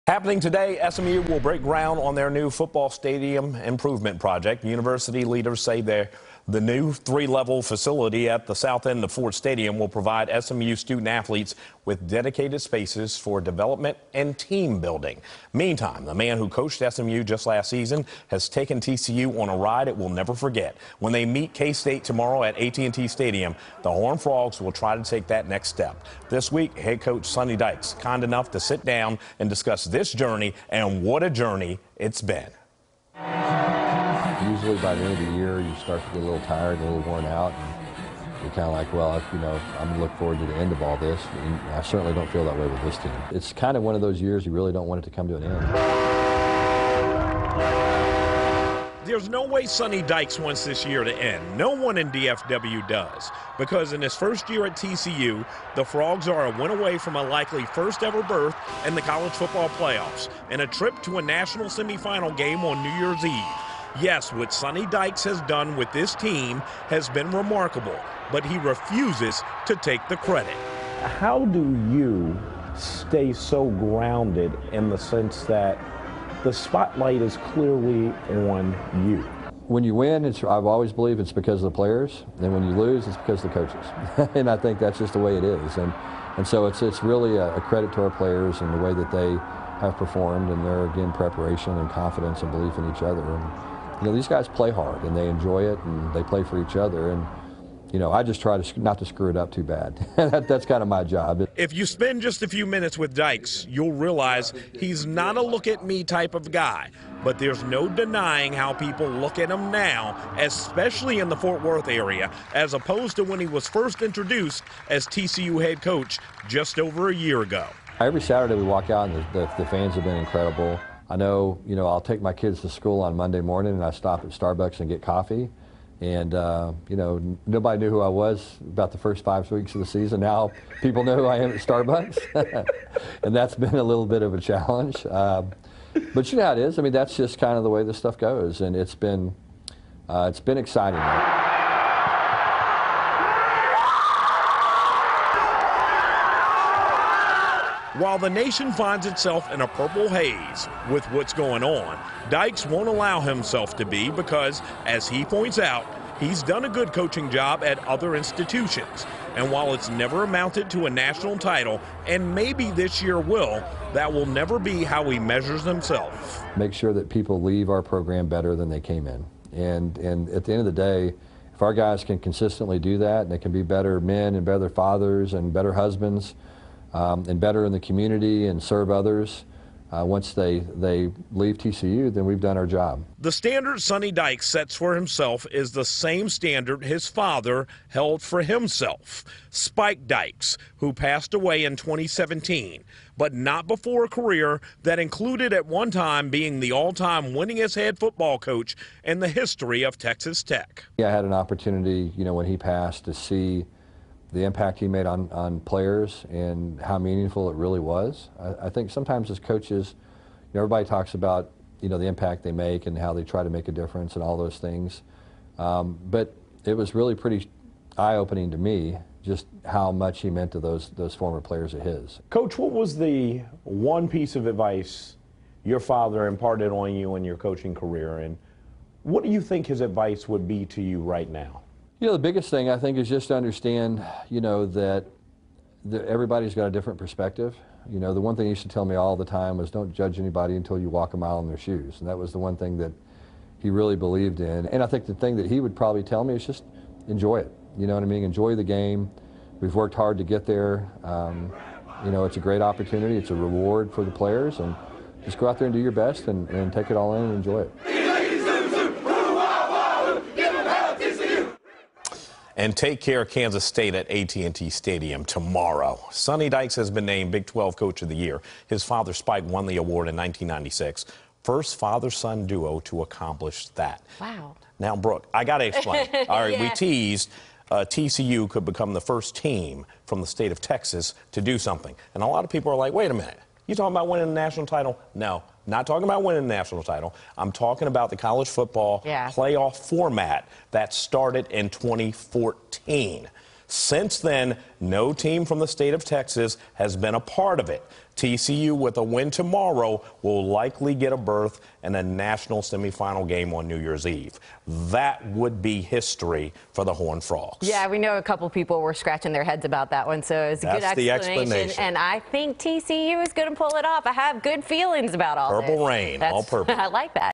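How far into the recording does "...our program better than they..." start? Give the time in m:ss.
2:47.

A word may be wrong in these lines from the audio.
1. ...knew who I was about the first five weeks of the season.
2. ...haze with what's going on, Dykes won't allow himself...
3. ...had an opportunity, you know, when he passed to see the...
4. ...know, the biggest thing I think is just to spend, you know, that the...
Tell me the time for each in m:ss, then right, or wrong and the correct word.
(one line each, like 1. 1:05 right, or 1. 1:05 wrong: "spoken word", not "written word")
1. 2:07 right
2. 2:30 right
3. 3:21 right
4. 3:52 wrong: "understand", not "spend".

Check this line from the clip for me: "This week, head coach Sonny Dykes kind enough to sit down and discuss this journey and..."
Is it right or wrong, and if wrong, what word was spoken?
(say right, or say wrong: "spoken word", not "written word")
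right.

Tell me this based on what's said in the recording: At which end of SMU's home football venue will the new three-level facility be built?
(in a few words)
South end.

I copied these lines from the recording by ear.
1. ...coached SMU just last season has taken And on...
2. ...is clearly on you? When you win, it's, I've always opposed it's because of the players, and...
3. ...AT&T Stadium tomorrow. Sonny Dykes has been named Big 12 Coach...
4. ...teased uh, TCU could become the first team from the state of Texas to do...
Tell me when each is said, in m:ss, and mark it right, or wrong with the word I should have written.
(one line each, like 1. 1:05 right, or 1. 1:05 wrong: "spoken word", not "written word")
1. 0:16 wrong: "TCU", not "And"
2. 1:17 wrong: "believed", not "opposed"
3. 4:24 right
4. 4:36 right.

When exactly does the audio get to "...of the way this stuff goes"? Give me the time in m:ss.
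2:17.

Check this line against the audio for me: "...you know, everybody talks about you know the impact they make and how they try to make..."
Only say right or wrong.
right.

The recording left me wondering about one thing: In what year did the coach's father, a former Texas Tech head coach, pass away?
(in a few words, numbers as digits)
2017.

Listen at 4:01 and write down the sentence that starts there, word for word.
And that was the one thing that he really believed in.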